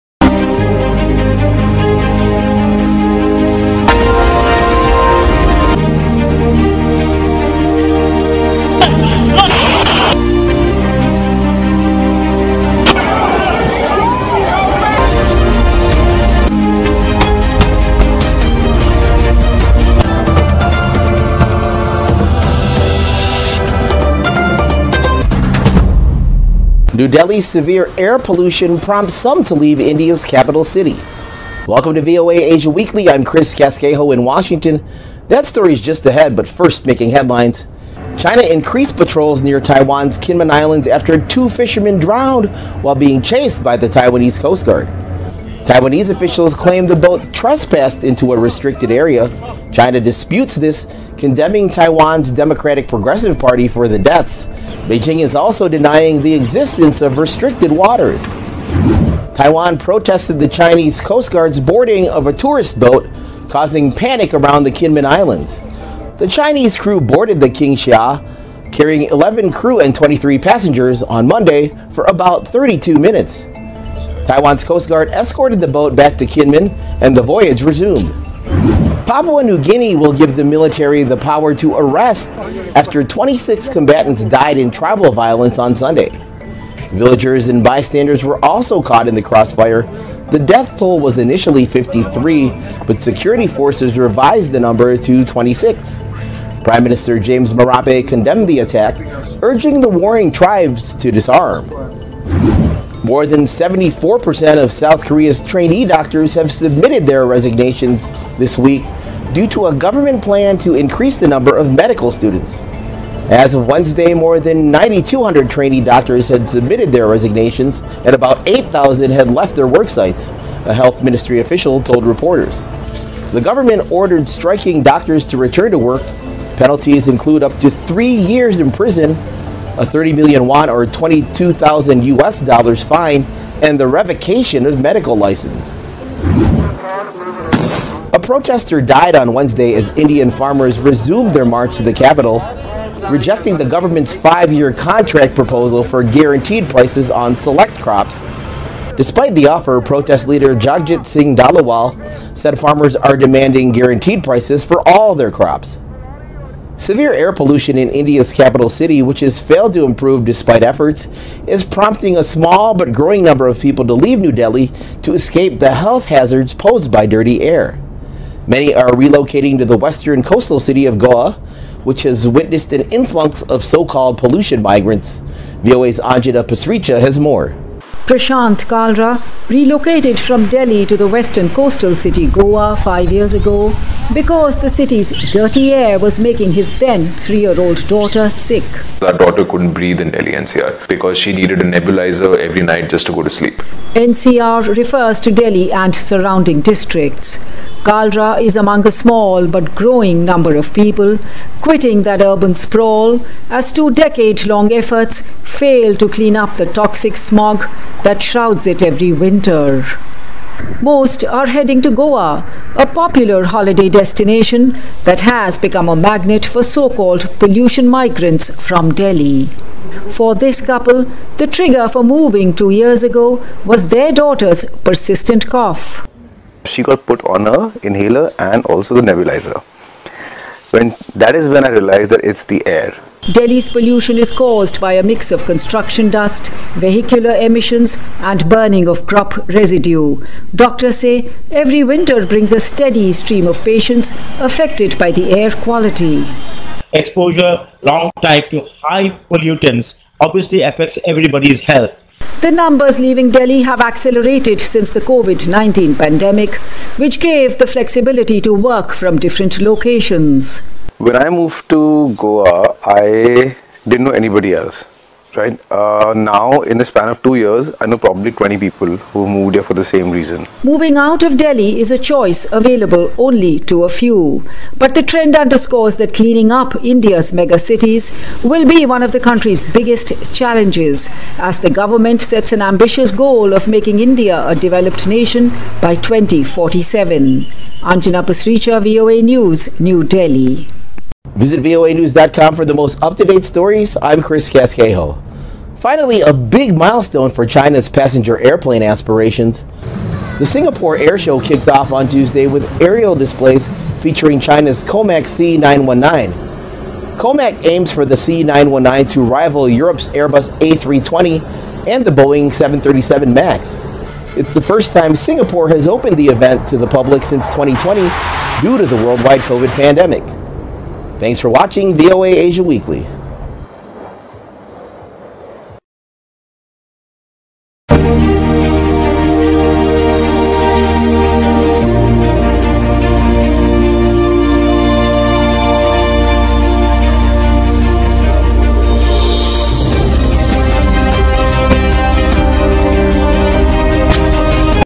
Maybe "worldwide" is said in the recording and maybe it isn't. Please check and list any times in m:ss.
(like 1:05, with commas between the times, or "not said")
5:19.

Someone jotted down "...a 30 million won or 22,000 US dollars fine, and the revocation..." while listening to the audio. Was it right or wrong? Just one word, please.
right.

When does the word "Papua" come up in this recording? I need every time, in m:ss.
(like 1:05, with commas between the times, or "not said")
1:19.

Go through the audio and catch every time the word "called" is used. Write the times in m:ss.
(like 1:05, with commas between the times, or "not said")
2:53, 3:36.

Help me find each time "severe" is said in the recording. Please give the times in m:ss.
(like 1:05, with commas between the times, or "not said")
0:27, 2:36.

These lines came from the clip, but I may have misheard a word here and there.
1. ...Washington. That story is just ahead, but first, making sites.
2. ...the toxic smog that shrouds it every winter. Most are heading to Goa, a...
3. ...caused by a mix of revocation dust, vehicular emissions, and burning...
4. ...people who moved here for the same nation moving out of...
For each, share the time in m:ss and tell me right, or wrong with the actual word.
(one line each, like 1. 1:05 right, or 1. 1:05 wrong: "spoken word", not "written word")
1. 0:34 wrong: "headlines", not "sites"
2. 3:26 right
3. 3:54 wrong: "construction", not "revocation"
4. 4:28 wrong: "reason", not "nation".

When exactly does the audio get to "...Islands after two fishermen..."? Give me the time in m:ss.
0:40.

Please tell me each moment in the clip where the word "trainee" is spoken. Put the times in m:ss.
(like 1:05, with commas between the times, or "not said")
1:45, 1:55.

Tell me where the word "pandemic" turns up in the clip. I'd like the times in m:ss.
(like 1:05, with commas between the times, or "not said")
4:15, 5:19.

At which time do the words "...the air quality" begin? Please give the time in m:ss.
4:05.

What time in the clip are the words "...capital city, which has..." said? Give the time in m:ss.
2:38.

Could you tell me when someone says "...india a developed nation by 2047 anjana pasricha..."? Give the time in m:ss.
4:43.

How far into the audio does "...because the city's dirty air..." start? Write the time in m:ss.
3:04.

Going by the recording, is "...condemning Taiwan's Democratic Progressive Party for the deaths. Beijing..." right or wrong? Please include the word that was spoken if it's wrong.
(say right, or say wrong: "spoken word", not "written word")
right.